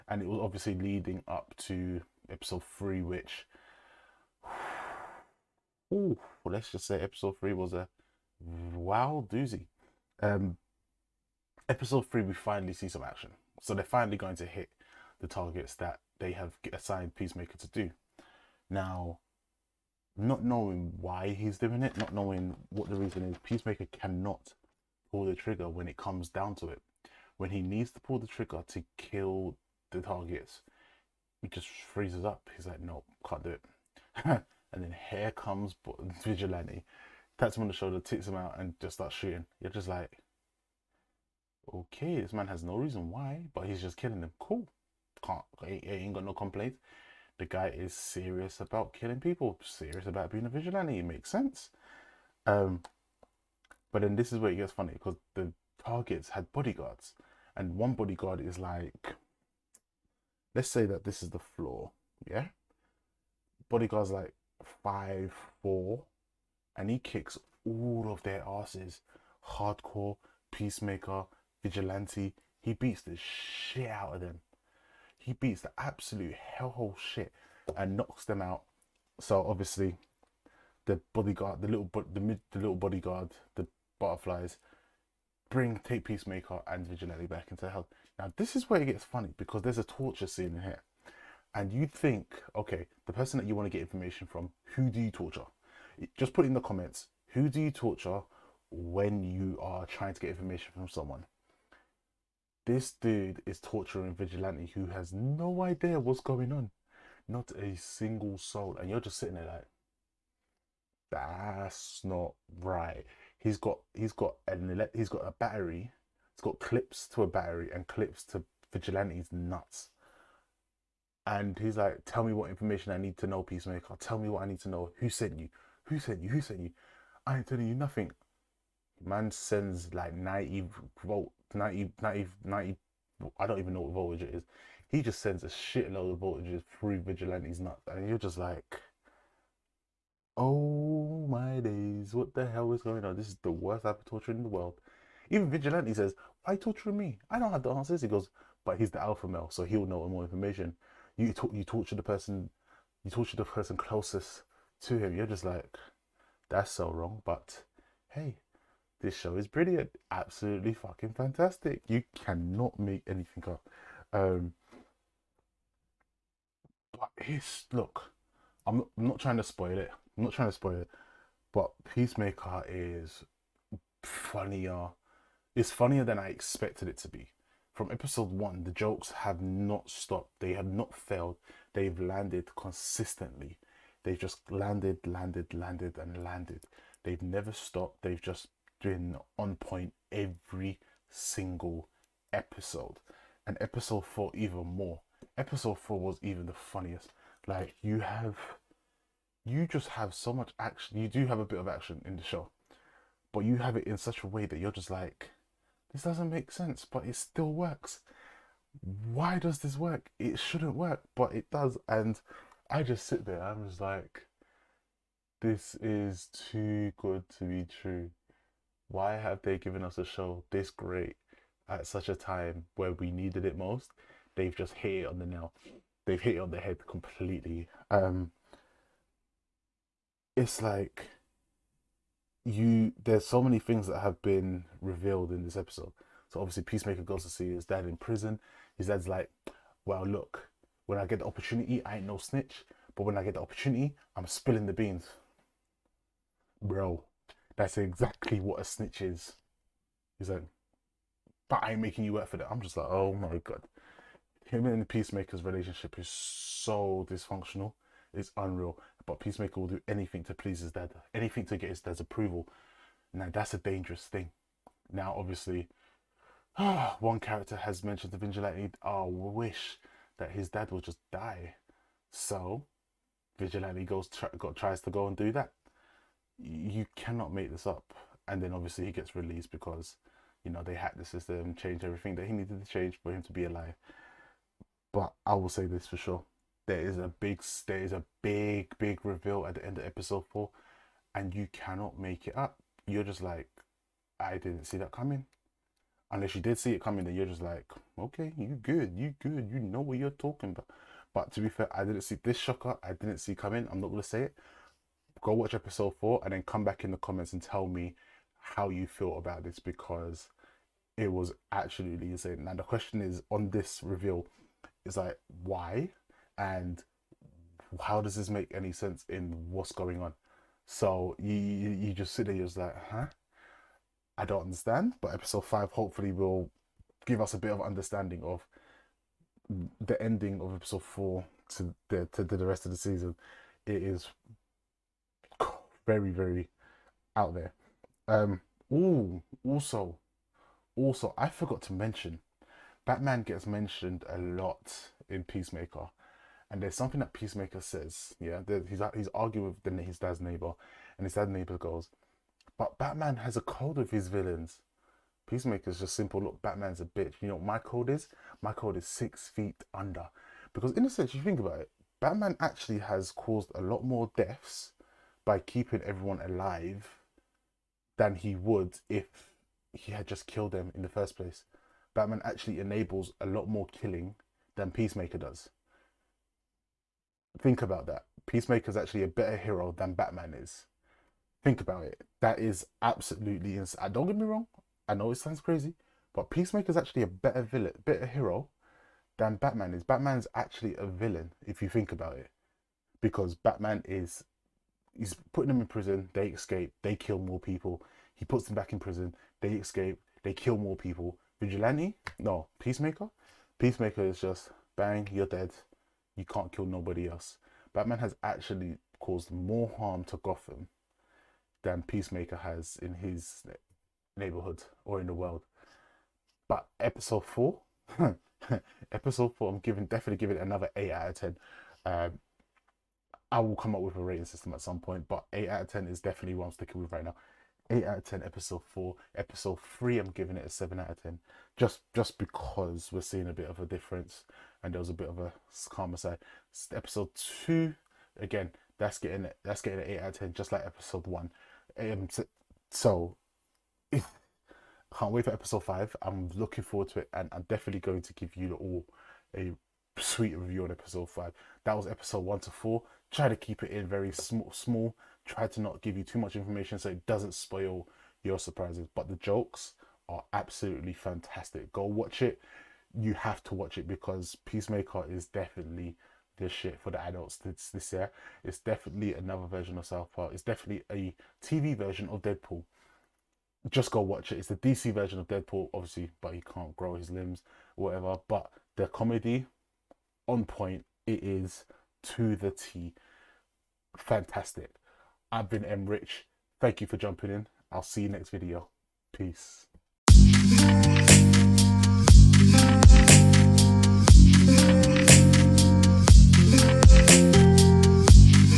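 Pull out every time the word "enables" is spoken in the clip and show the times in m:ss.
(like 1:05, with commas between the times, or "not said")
6:12.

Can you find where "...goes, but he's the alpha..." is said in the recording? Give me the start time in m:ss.
2:28.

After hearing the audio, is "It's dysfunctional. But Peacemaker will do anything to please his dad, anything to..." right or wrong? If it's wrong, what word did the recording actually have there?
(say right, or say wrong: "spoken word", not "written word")
wrong: "unreal", not "dysfunctional".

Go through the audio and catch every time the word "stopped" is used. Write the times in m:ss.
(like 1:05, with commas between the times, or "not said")
2:59, 3:07.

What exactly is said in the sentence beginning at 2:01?
And he's like, tell me what information I need to know, Peacemaker.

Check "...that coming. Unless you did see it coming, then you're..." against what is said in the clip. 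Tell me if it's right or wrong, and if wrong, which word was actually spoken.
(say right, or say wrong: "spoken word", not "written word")
right.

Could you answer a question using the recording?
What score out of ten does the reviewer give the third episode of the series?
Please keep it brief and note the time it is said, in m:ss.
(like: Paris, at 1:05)
7, at 7:10.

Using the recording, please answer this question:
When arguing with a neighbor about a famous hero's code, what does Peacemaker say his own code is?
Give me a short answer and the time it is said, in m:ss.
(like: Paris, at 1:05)
Six feet under, at 5:58.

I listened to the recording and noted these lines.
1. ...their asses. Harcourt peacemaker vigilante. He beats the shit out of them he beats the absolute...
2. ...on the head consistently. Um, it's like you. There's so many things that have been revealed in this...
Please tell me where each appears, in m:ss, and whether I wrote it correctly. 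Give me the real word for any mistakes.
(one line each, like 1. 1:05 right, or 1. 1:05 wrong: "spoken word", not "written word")
1. 1:08 right
2. 3:46 wrong: "completely", not "consistently".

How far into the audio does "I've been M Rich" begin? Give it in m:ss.
8:05.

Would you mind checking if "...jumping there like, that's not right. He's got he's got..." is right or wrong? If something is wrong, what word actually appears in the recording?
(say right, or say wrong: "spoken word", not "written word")
wrong: "sitting", not "jumping".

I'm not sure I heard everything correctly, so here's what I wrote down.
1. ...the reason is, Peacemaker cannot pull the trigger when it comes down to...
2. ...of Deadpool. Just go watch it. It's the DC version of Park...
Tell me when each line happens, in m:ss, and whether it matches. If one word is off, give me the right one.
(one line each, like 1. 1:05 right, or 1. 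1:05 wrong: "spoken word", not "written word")
1. 0:22 right
2. 7:52 wrong: "Deadpool", not "Park".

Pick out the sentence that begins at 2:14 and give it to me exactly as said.
He just sends a shitload of voltages through Vigilante's nuts.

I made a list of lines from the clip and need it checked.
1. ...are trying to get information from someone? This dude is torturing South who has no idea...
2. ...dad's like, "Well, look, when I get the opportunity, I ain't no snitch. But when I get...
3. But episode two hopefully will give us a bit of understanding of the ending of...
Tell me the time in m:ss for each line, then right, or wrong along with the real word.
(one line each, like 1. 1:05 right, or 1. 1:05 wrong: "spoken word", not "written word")
1. 1:39 wrong: "Vigilante", not "South"
2. 3:58 right
3. 5:25 wrong: "five", not "two".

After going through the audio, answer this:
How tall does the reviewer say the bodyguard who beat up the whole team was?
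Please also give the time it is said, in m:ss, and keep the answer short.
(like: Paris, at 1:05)
5'4", at 1:04.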